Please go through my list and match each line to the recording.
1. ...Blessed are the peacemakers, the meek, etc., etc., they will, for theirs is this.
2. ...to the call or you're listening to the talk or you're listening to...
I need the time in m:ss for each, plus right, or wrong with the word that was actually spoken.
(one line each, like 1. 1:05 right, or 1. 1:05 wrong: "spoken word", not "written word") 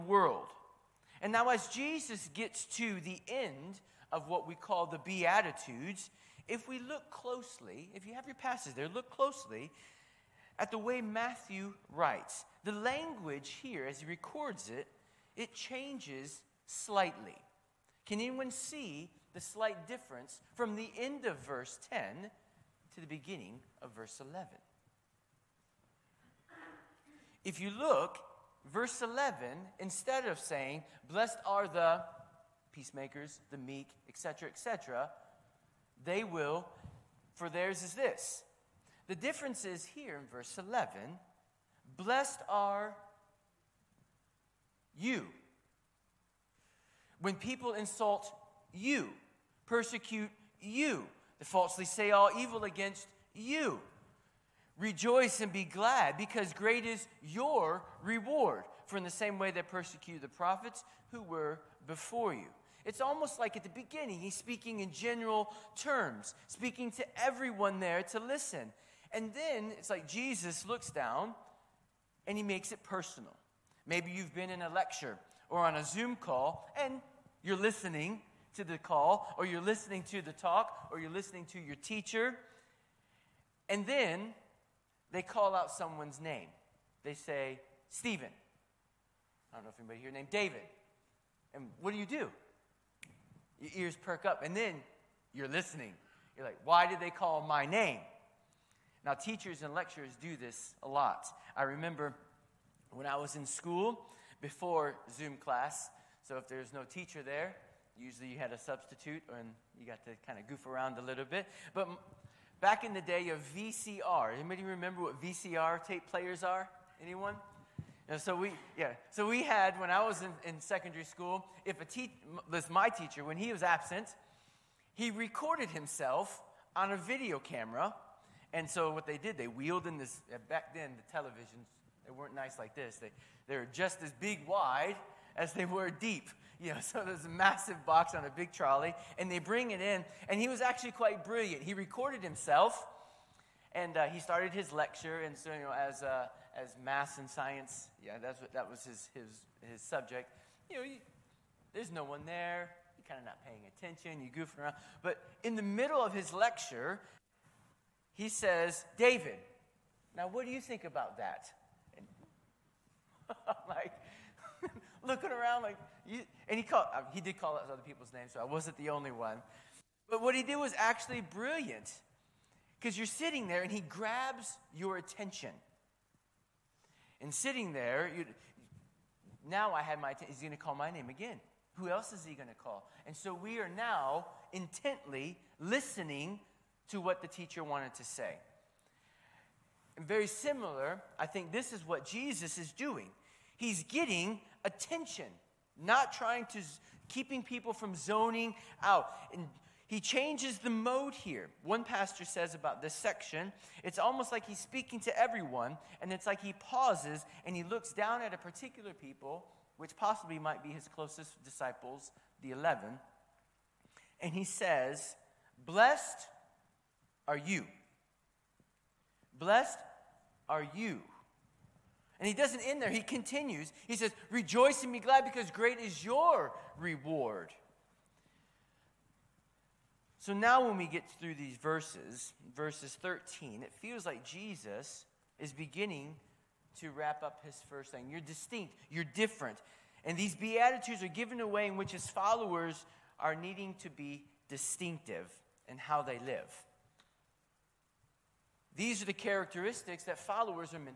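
1. 0:31 right
2. 1:18 right.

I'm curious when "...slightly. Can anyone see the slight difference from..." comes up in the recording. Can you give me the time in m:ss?
0:16.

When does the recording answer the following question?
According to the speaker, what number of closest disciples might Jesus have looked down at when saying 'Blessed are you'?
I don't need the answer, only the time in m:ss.
3:32.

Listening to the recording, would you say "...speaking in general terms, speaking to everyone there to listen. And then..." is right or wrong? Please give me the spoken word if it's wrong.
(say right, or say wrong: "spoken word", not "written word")
right.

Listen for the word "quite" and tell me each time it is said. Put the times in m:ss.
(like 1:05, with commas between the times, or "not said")
2:20.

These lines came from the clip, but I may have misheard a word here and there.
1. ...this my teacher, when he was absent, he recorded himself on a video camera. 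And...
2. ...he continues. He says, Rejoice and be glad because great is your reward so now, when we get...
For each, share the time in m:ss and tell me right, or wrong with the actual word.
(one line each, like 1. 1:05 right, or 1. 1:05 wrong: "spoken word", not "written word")
1. 2:02 right
2. 3:42 right.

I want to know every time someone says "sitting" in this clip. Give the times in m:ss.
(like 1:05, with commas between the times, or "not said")
2:53, 2:57.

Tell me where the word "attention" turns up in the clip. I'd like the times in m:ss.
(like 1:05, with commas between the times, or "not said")
2:33, 2:54, 3:00, 3:14.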